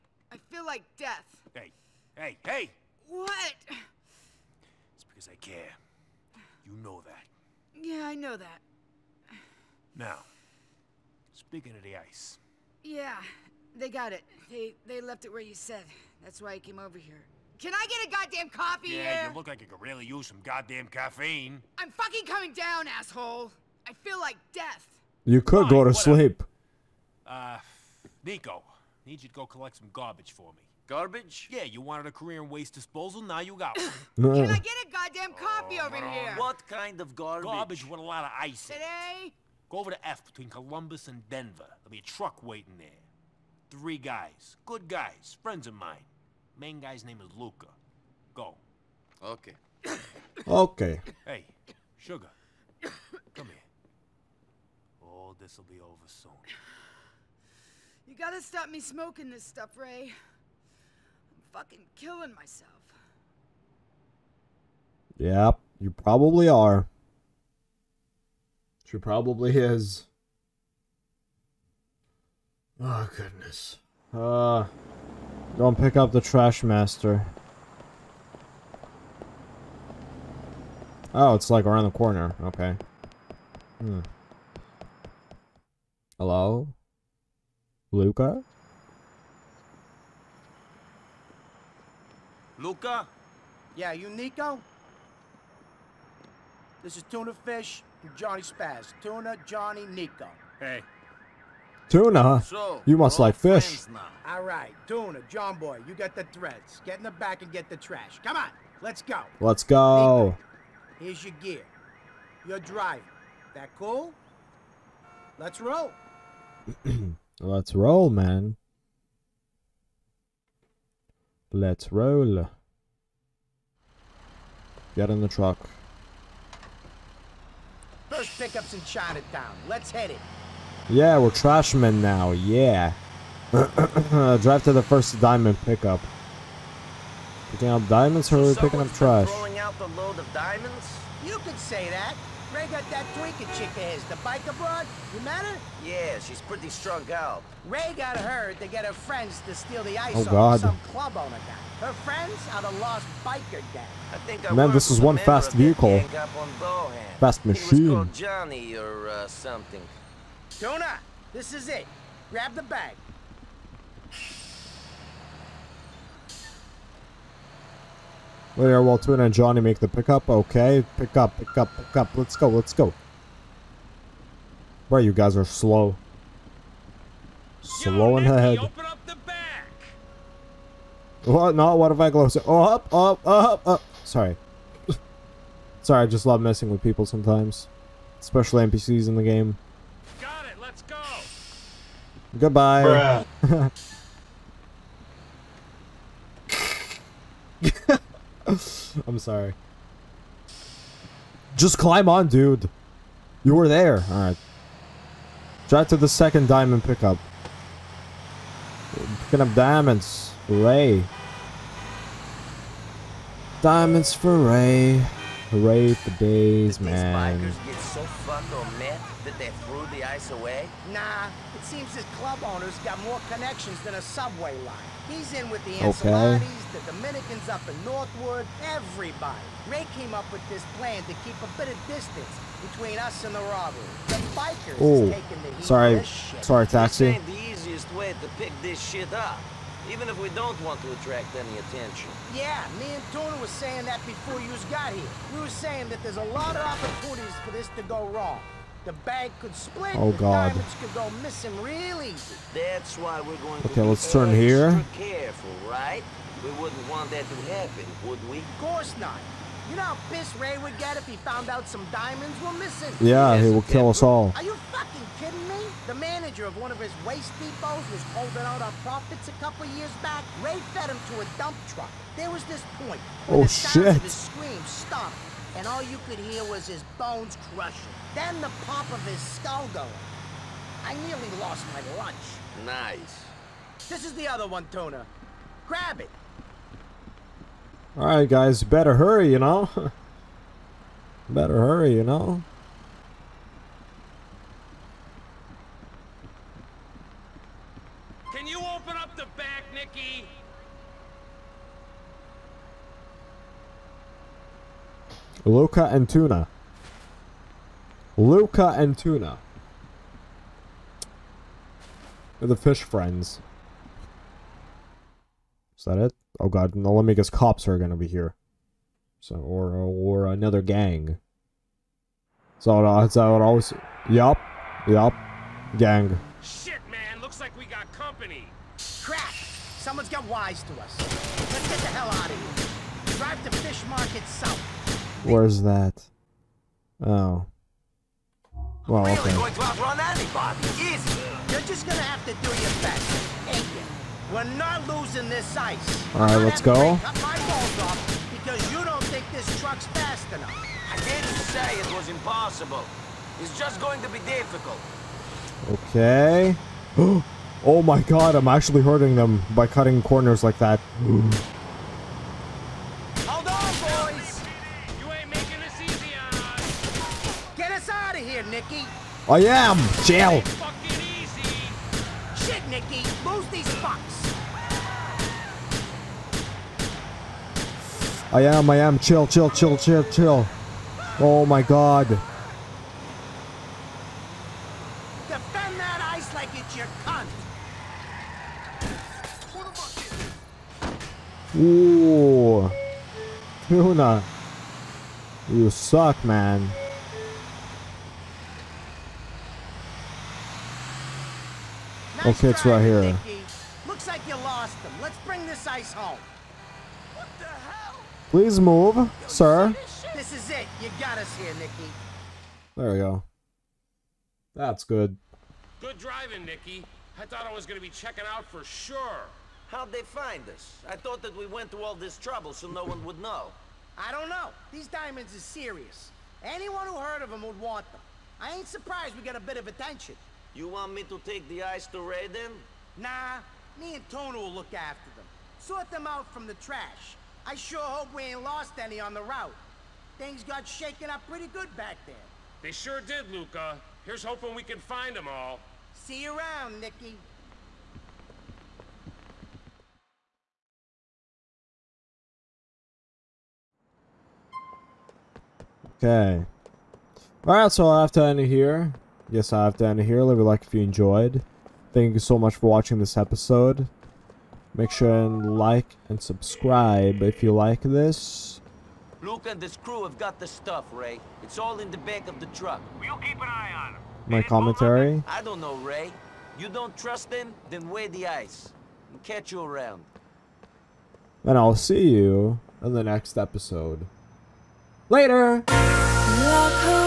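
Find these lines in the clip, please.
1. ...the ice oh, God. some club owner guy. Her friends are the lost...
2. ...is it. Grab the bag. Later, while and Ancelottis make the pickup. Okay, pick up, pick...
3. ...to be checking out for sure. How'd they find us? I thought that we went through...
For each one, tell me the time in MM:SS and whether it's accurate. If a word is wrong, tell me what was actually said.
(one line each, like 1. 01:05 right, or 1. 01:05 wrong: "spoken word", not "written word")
1. 02:29 right
2. 02:41 wrong: "Johnny", not "Ancelottis"
3. 06:57 right.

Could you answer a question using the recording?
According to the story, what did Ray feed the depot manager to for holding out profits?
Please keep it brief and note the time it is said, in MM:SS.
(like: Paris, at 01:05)
A dump truck, at 04:31.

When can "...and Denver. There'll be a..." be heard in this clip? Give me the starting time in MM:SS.
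00:41.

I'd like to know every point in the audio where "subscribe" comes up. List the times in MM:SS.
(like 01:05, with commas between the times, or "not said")
07:46.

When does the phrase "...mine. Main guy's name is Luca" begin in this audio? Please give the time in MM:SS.
00:45.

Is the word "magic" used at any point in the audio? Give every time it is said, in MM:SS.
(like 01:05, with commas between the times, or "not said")
not said.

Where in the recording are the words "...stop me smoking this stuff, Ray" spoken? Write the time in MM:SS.
00:58.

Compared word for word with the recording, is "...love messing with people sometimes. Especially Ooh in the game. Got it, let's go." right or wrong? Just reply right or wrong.
wrong.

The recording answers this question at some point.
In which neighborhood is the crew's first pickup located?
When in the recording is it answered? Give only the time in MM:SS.
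02:08.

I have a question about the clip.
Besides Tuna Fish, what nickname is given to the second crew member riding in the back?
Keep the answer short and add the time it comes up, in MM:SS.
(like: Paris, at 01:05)
Johnny Spaz, at 01:38.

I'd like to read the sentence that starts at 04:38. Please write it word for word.
Then the pop of his skull going.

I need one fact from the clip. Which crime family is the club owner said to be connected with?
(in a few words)
The Ancelottis.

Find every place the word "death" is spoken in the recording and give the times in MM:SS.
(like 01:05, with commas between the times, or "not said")
00:00, 00:24.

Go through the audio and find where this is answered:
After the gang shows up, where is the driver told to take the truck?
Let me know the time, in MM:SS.
05:33.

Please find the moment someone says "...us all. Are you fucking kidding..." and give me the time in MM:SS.
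04:23.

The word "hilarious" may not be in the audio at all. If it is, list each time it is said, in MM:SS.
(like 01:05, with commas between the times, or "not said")
not said.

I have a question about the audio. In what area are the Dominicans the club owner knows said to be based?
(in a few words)
Northwood.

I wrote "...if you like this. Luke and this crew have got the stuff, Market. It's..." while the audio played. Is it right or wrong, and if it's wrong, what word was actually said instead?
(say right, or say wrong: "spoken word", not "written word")
wrong: "Ray", not "Market".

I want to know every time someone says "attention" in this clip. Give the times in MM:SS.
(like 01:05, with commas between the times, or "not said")
04:01, 07:09.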